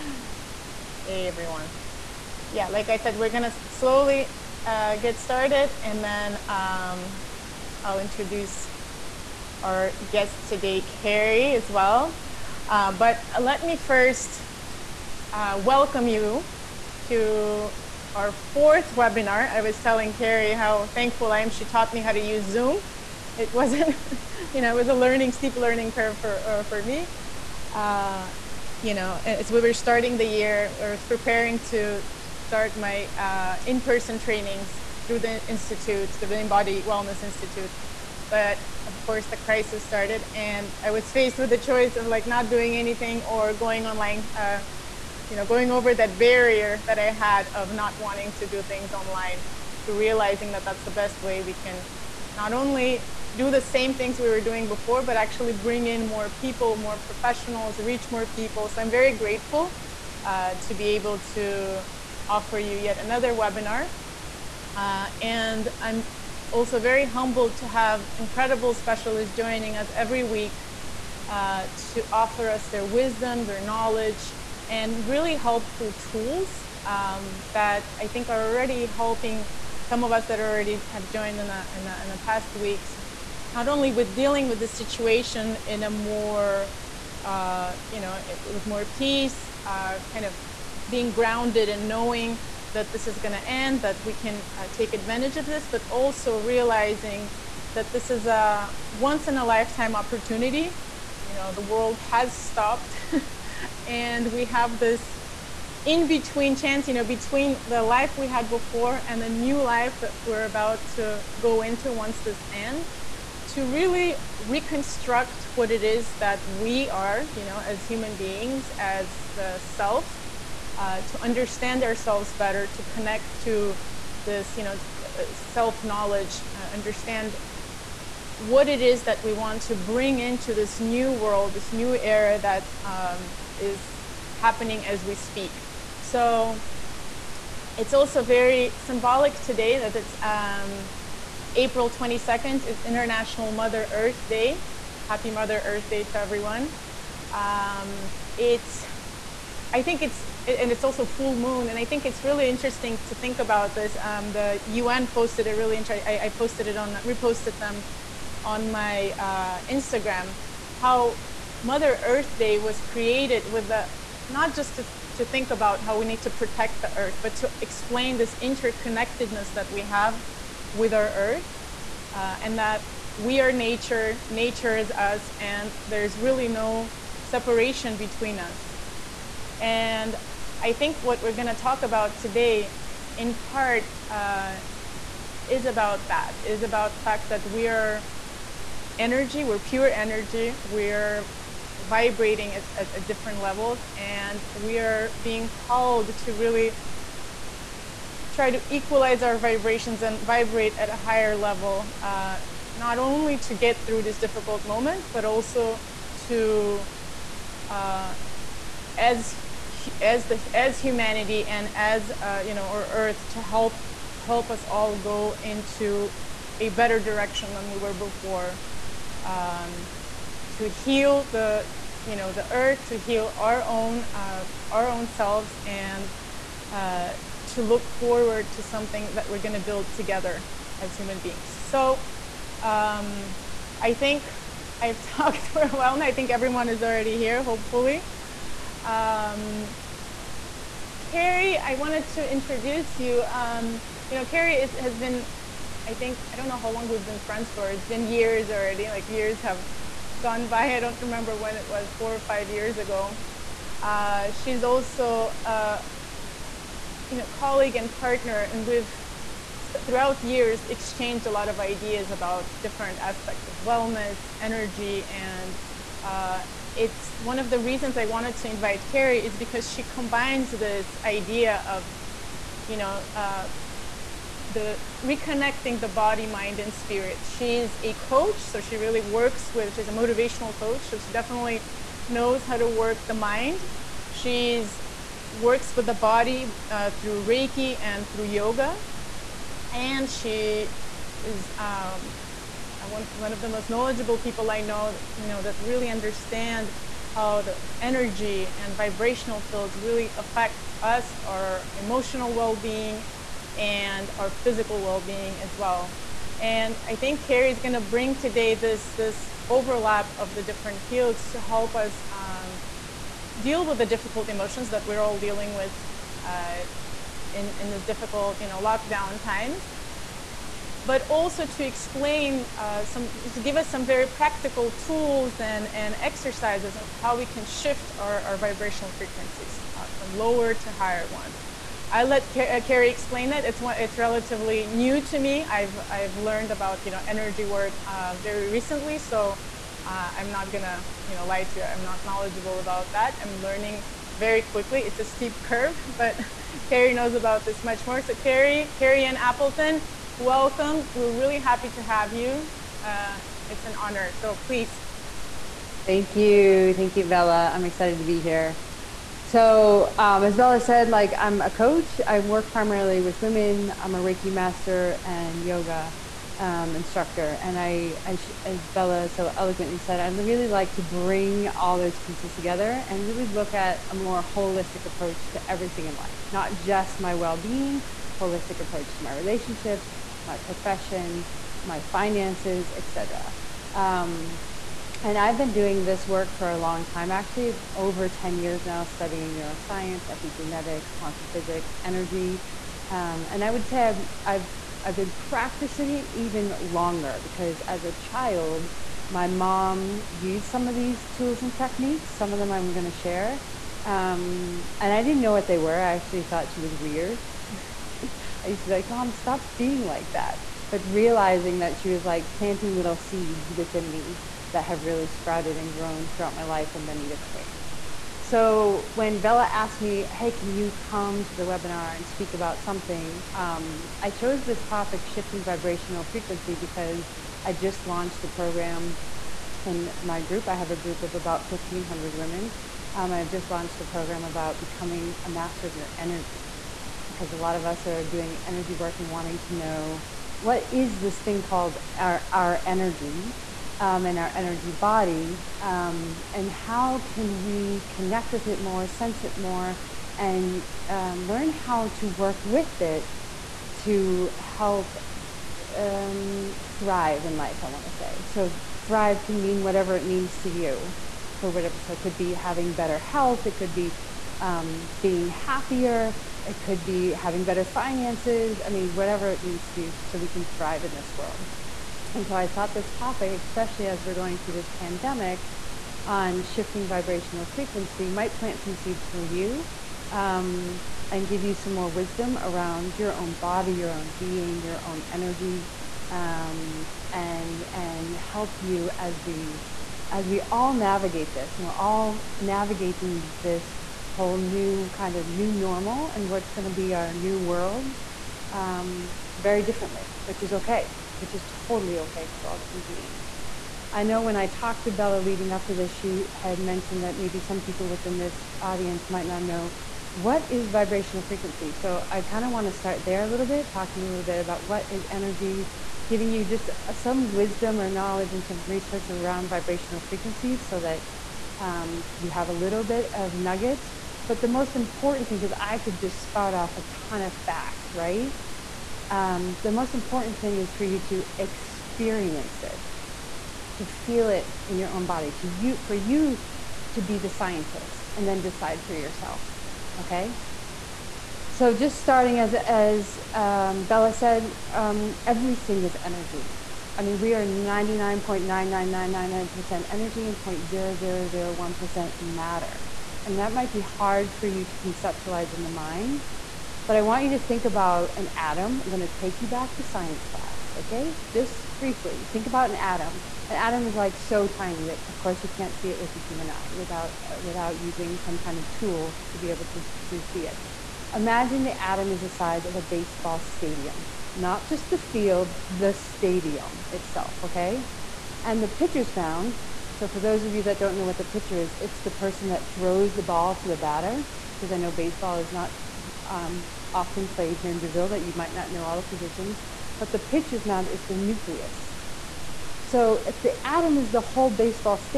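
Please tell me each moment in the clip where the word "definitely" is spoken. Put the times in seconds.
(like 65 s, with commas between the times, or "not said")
281 s.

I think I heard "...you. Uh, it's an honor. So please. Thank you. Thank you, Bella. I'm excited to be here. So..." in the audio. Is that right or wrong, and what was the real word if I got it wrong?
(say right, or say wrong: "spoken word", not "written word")
right.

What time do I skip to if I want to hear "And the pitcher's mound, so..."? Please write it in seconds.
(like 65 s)
578 s.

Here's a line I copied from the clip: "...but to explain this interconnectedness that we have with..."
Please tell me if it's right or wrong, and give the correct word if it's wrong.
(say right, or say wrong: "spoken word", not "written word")
right.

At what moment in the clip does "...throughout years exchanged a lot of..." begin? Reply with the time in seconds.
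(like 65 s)
259 s.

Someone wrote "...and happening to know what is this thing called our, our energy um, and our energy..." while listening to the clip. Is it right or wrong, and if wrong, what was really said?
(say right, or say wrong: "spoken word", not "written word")
wrong: "wanting", not "happening".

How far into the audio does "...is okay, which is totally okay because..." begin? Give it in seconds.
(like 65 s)
500 s.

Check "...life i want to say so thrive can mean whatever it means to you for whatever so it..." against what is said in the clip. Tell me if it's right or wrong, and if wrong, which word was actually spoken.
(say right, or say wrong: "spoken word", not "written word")
right.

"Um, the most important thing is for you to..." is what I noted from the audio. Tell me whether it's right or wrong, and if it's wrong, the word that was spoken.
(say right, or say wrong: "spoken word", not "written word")
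right.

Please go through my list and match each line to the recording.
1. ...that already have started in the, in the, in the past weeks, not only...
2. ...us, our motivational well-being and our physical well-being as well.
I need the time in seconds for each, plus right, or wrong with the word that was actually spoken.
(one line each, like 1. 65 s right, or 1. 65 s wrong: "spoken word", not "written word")
1. 80 s wrong: "joined", not "started"
2. 300 s wrong: "emotional", not "motivational".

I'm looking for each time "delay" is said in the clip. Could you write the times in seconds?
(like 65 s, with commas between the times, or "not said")
not said.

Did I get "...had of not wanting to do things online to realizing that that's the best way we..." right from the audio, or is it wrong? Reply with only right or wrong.
right.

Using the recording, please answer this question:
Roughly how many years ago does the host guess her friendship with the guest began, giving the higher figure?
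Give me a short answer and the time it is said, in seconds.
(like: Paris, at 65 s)
5, at 252 s.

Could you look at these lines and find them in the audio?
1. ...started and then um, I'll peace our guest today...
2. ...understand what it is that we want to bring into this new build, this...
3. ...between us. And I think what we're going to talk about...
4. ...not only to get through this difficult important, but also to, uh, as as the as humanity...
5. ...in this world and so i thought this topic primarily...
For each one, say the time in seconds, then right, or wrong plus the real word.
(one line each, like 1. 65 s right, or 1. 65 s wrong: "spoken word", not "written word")
1. 5 s wrong: "introduce", not "peace"
2. 126 s wrong: "world", not "build"
3. 177 s right
4. 202 s wrong: "moment", not "important"
5. 470 s wrong: "especially", not "primarily".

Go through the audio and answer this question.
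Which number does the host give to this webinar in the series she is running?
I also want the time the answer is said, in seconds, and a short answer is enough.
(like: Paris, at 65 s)
fourth, at 18 s.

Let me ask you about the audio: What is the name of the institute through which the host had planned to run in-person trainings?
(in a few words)
Imbody Wellness Institute.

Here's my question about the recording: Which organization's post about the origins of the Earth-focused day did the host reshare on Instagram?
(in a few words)
the UN.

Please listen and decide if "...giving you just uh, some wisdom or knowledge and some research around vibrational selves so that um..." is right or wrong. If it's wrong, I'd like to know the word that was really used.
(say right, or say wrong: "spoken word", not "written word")
wrong: "frequencies", not "selves".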